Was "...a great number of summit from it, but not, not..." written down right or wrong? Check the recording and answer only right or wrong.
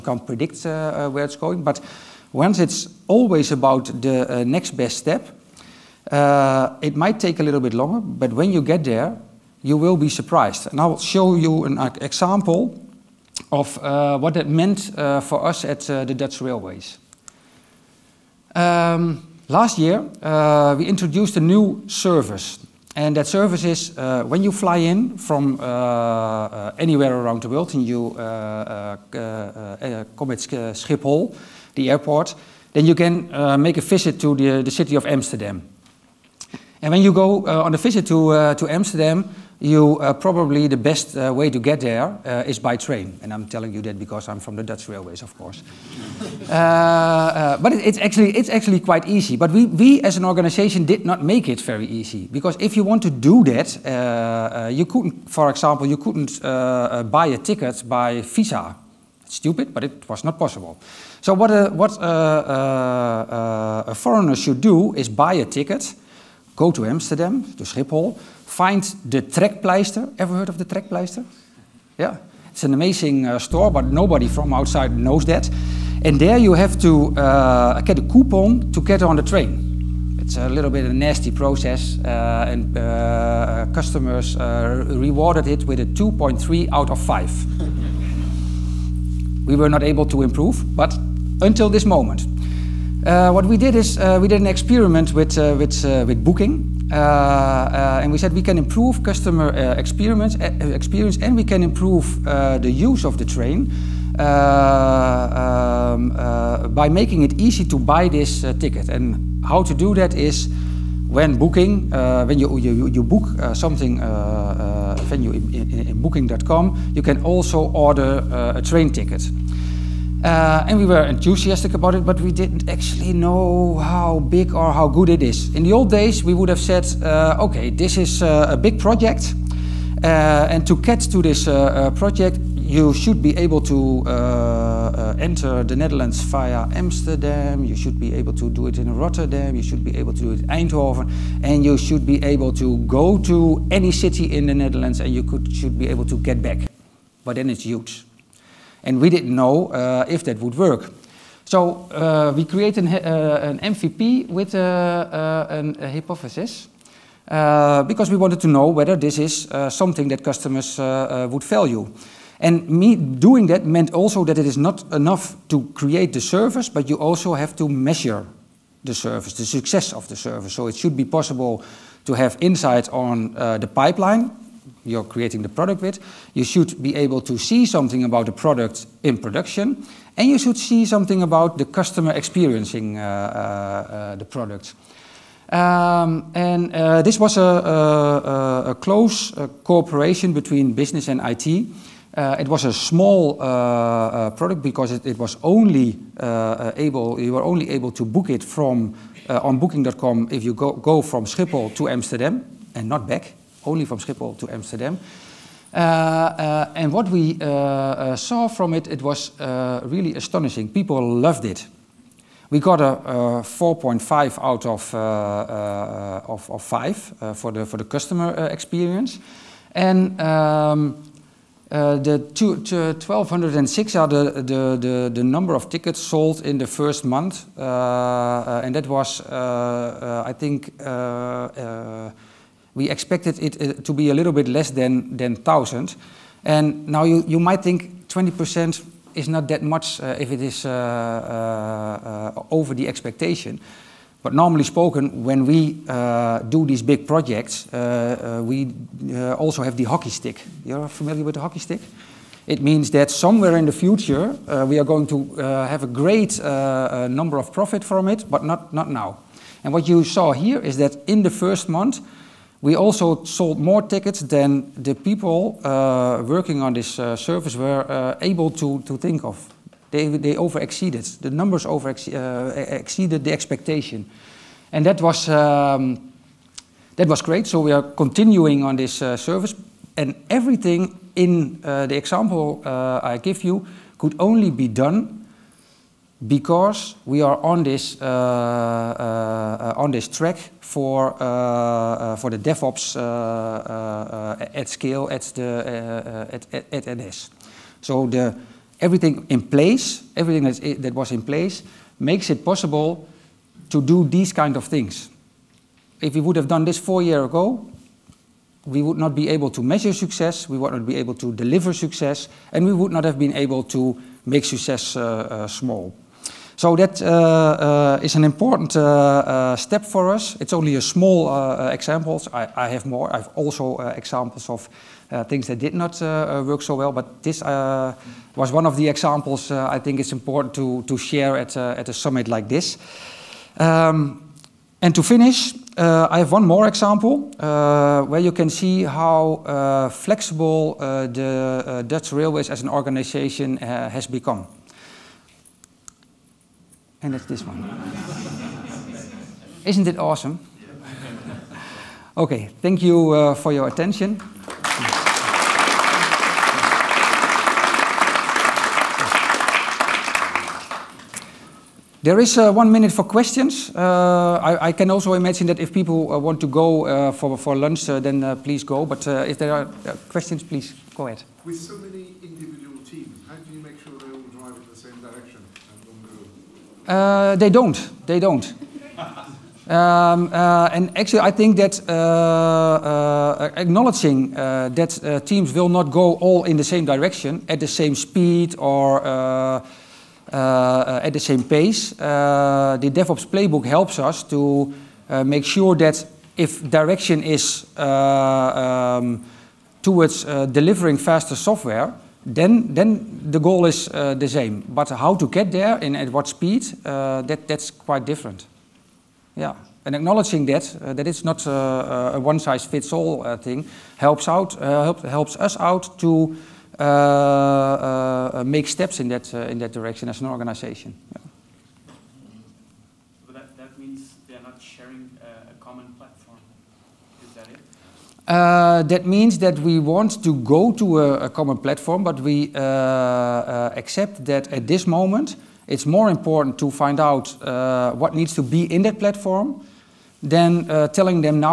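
wrong.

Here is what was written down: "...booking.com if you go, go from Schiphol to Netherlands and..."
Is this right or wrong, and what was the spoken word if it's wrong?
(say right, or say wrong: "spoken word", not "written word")
wrong: "Amsterdam", not "Netherlands".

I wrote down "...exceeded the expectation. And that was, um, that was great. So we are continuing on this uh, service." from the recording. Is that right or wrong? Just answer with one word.
right.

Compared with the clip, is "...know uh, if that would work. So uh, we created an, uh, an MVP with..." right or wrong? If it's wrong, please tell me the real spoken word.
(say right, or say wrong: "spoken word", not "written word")
right.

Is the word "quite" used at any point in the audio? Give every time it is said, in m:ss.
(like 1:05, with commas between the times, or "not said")
0:48, 6:47.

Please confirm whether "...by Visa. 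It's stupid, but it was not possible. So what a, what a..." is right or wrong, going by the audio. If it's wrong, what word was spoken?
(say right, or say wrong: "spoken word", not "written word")
right.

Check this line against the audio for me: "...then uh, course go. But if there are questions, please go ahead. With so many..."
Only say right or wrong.
wrong.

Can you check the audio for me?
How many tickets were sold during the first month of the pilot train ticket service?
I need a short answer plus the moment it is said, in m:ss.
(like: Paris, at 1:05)
1206, at 3:42.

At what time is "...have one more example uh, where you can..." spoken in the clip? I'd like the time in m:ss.
5:36.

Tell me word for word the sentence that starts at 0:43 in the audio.
And I'm telling you that because I'm from the Dutch railways, of course.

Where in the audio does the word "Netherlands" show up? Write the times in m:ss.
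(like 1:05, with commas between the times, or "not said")
2:15, 2:24.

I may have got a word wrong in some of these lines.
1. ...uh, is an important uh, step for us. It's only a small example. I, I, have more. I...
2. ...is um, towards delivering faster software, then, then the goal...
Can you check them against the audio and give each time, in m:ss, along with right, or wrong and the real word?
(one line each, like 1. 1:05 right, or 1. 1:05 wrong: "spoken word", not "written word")
1. 5:17 right
2. 6:37 right.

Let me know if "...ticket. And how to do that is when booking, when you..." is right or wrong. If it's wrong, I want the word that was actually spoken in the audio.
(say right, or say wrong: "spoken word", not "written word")
right.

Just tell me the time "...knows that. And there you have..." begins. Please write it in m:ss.
1:14.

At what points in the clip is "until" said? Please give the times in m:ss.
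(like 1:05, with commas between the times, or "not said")
1:31.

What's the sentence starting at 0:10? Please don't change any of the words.
And I'll show you an uh, example of uh, what that meant uh, for us at uh, the Dutch Railways.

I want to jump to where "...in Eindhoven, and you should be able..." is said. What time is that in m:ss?
2:20.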